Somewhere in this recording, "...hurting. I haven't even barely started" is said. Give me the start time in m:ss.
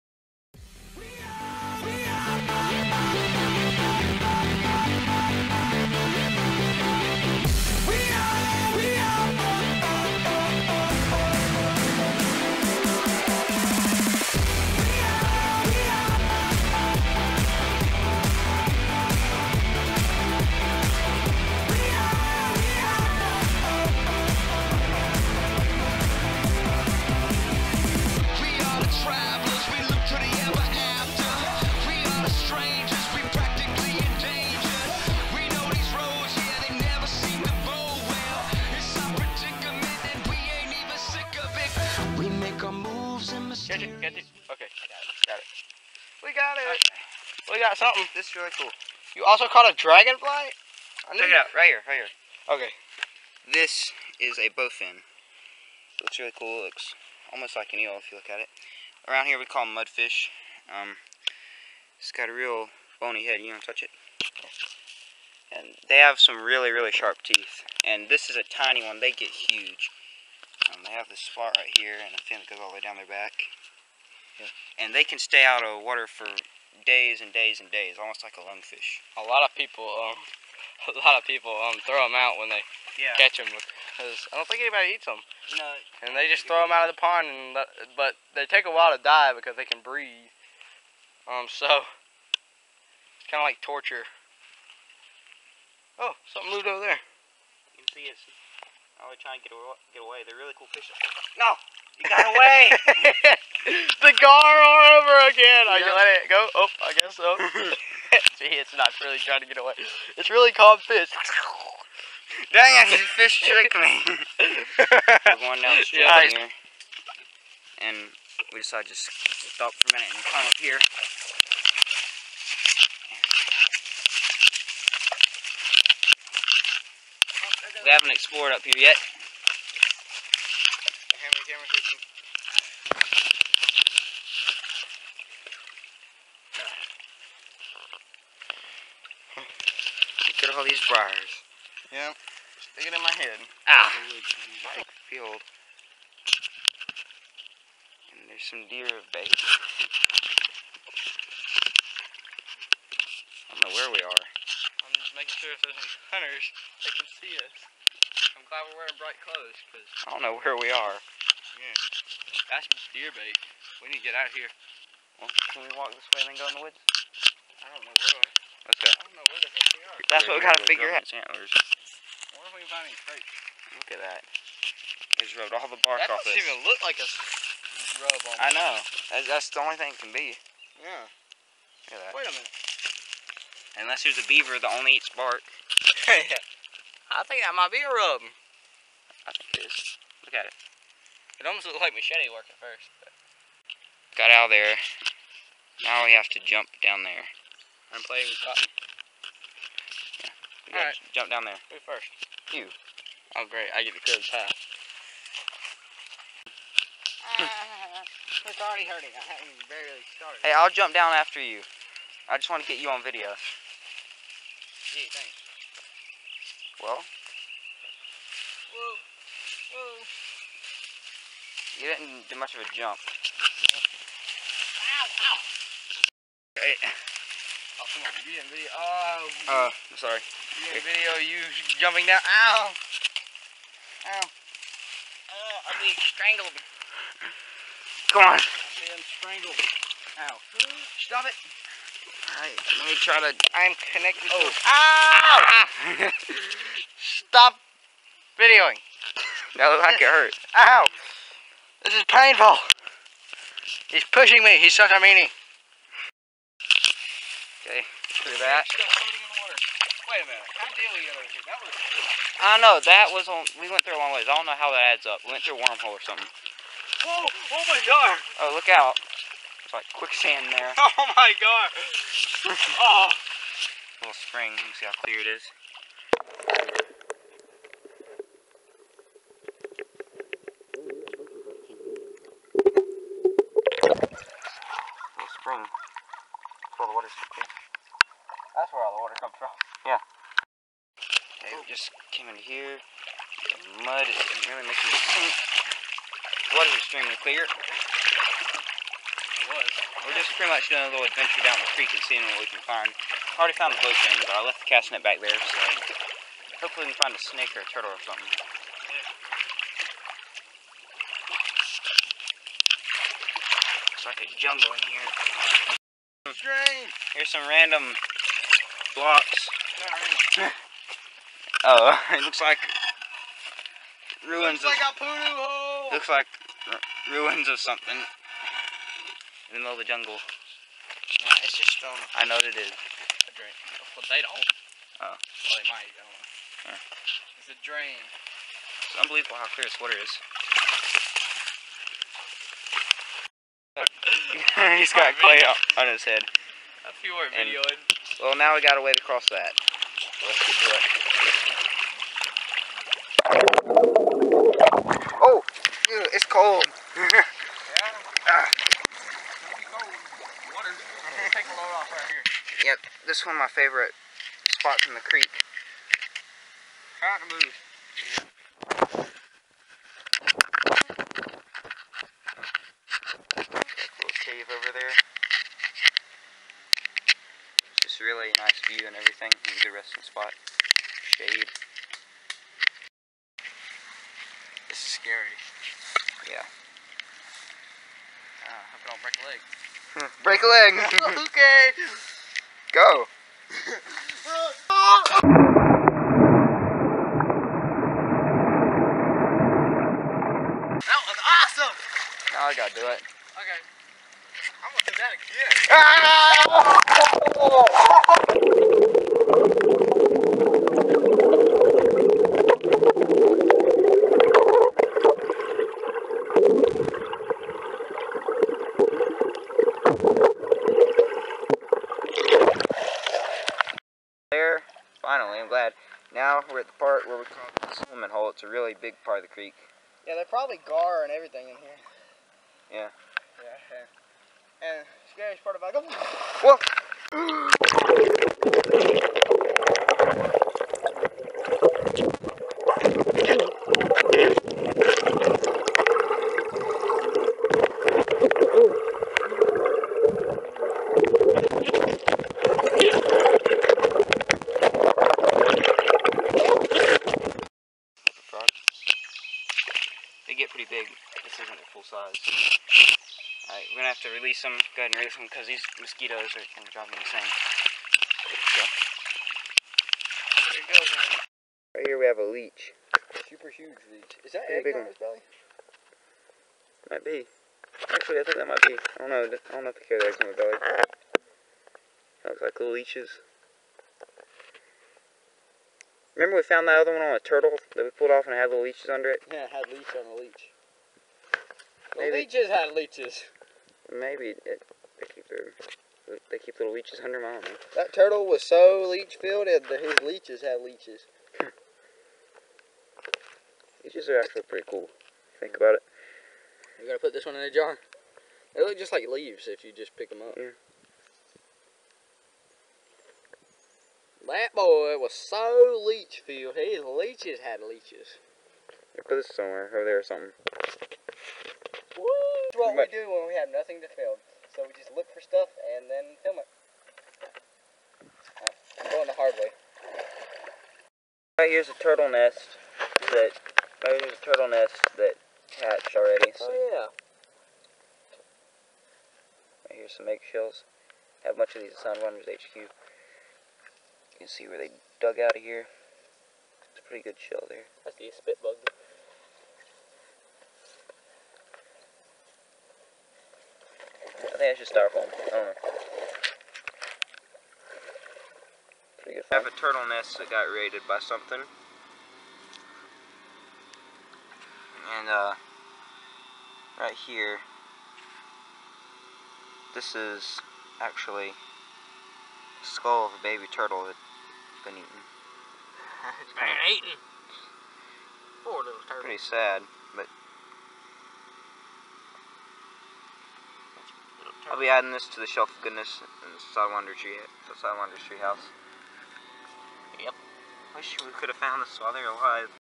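3:28.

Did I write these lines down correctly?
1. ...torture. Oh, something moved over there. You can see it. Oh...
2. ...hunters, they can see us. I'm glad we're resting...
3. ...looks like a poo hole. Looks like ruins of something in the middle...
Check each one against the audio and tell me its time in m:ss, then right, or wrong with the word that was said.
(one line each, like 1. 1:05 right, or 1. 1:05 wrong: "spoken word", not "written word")
1. 1:33 right
2. 2:36 wrong: "wearing", not "resting"
3. 5:24 right.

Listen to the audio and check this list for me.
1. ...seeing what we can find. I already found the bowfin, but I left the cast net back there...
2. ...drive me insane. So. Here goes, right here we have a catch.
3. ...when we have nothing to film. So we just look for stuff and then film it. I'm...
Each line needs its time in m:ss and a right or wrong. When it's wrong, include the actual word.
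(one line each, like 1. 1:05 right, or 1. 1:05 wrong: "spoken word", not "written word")
1. 5:02 right
2. 7:46 wrong: "leech", not "catch"
3. 8:43 right.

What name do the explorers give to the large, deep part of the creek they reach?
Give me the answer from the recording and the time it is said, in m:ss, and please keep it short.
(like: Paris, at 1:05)
The swimming hole, at 7:07.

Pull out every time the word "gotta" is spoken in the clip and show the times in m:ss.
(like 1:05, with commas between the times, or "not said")
2:50, 5:48, 6:42, 8:26.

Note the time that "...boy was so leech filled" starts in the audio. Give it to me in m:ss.
8:34.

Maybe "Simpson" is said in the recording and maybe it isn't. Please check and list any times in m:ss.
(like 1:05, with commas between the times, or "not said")
not said.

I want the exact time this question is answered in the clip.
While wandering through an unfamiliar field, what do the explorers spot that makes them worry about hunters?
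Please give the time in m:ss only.
2:28.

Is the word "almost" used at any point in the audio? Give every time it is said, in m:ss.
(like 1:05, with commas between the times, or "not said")
0:57, 1:18, 3:11.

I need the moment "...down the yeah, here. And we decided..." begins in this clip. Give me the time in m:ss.
1:55.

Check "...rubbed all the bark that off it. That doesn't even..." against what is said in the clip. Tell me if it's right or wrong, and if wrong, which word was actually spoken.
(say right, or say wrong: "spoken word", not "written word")
right.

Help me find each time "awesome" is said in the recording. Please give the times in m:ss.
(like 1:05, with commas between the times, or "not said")
6:41.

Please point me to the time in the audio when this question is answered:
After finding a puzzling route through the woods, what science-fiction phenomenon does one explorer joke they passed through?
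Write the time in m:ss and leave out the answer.
4:25.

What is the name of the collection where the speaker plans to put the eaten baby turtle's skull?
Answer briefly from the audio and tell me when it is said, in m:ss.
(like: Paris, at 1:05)
Shelf of Goodness, at 9:45.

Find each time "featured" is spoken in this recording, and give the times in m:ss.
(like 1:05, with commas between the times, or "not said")
not said.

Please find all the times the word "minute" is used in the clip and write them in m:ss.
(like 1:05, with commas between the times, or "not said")
1:59, 3:02, 4:20.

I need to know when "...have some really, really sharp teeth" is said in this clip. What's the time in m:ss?
1:05.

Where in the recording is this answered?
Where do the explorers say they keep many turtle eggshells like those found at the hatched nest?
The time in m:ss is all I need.
9:02.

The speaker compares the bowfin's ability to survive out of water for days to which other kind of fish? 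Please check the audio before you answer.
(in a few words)
Lungfish.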